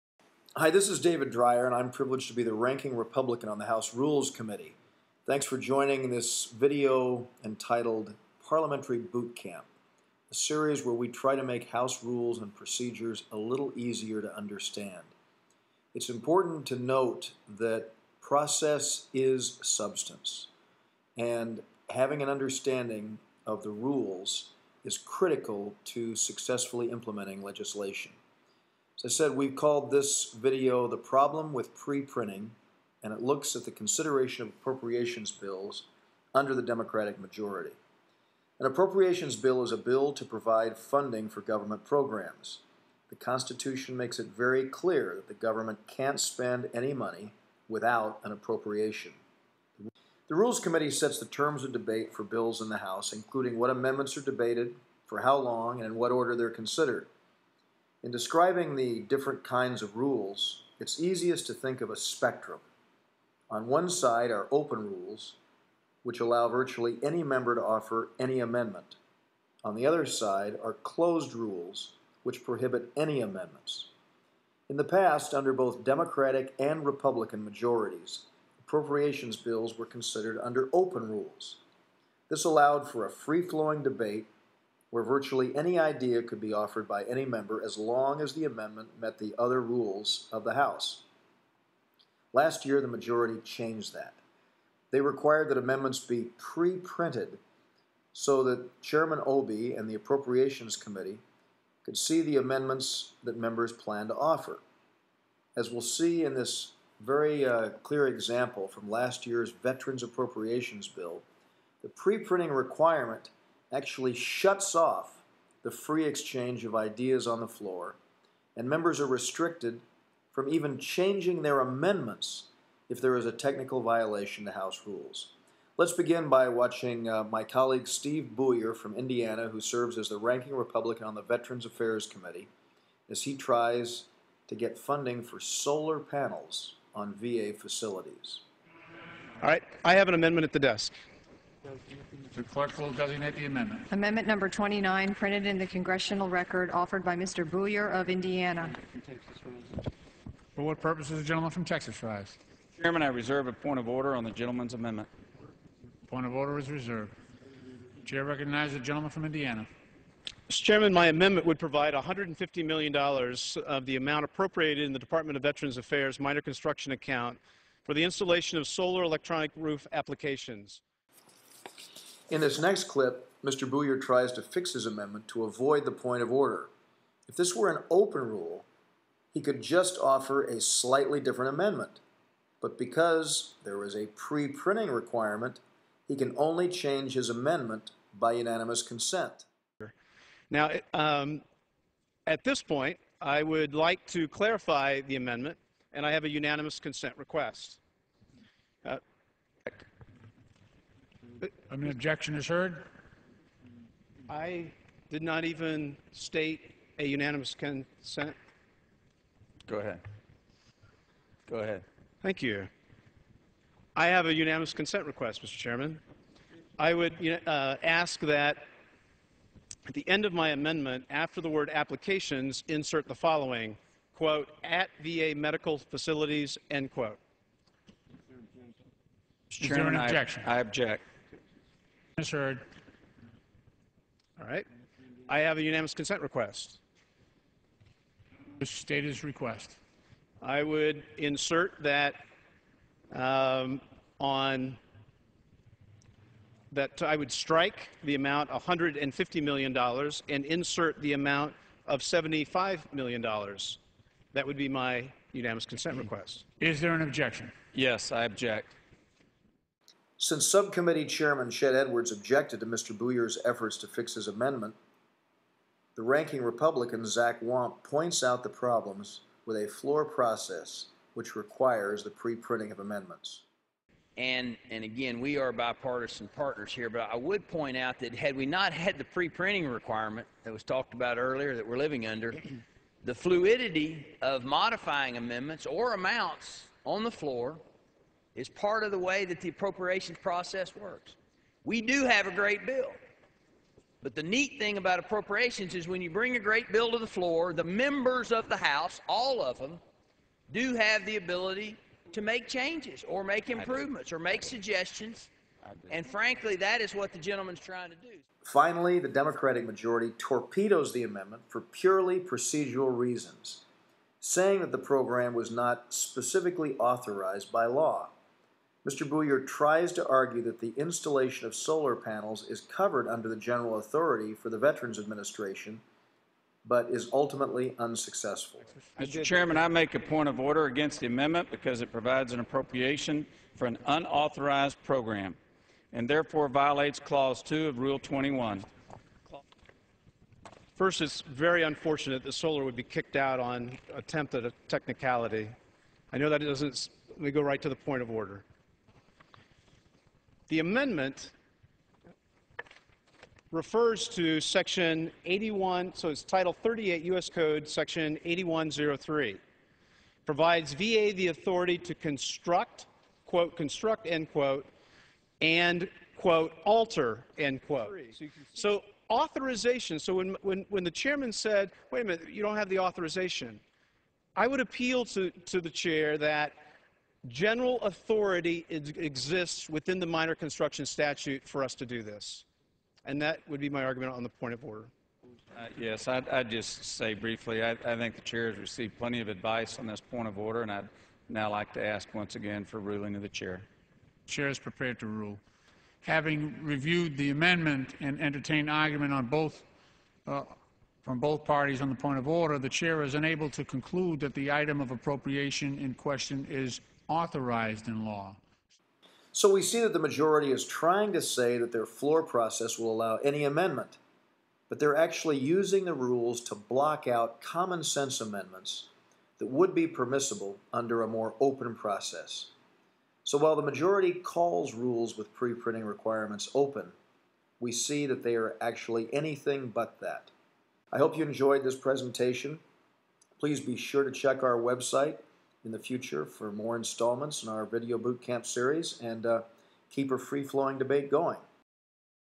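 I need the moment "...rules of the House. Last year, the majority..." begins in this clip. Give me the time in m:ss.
1:29.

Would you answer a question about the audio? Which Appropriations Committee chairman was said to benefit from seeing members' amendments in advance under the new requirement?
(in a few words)
Chairman Obey.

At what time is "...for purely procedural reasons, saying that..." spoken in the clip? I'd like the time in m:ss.
5:11.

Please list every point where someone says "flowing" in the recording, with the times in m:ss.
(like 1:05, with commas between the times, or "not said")
1:23, 7:20.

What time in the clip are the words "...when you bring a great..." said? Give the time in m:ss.
4:55.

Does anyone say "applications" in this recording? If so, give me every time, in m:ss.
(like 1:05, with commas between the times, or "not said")
2:49, 3:41.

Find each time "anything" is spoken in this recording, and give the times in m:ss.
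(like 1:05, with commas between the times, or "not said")
7:09.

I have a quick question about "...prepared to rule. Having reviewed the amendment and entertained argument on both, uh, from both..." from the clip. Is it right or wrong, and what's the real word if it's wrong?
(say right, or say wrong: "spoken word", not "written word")
right.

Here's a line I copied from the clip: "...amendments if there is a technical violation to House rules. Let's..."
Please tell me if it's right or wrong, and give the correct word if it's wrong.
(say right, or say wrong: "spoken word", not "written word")
right.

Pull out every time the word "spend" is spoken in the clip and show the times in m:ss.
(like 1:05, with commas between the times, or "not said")
0:46.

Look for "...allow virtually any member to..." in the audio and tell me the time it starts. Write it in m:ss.
1:06.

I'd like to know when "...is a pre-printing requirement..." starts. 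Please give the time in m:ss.
3:03.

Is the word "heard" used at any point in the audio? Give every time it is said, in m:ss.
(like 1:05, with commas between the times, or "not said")
3:22, 3:52.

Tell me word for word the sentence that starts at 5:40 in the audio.
First, it's very unfortunate that solar would be kicked out on attempt at a technicality.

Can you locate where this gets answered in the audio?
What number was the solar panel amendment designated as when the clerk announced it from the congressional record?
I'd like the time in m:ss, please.
2:23.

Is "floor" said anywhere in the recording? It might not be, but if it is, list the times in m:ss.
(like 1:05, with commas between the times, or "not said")
1:57, 4:29, 4:47, 4:57, 6:51.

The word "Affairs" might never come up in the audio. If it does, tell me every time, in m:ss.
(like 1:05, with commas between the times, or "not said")
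2:11, 2:45.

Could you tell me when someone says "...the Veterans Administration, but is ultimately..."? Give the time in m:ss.
5:24.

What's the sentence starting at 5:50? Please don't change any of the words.
The amendment refers to section 81, so it's title 38 U.S.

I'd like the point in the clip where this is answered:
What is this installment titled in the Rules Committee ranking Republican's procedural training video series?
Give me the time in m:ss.
0:30.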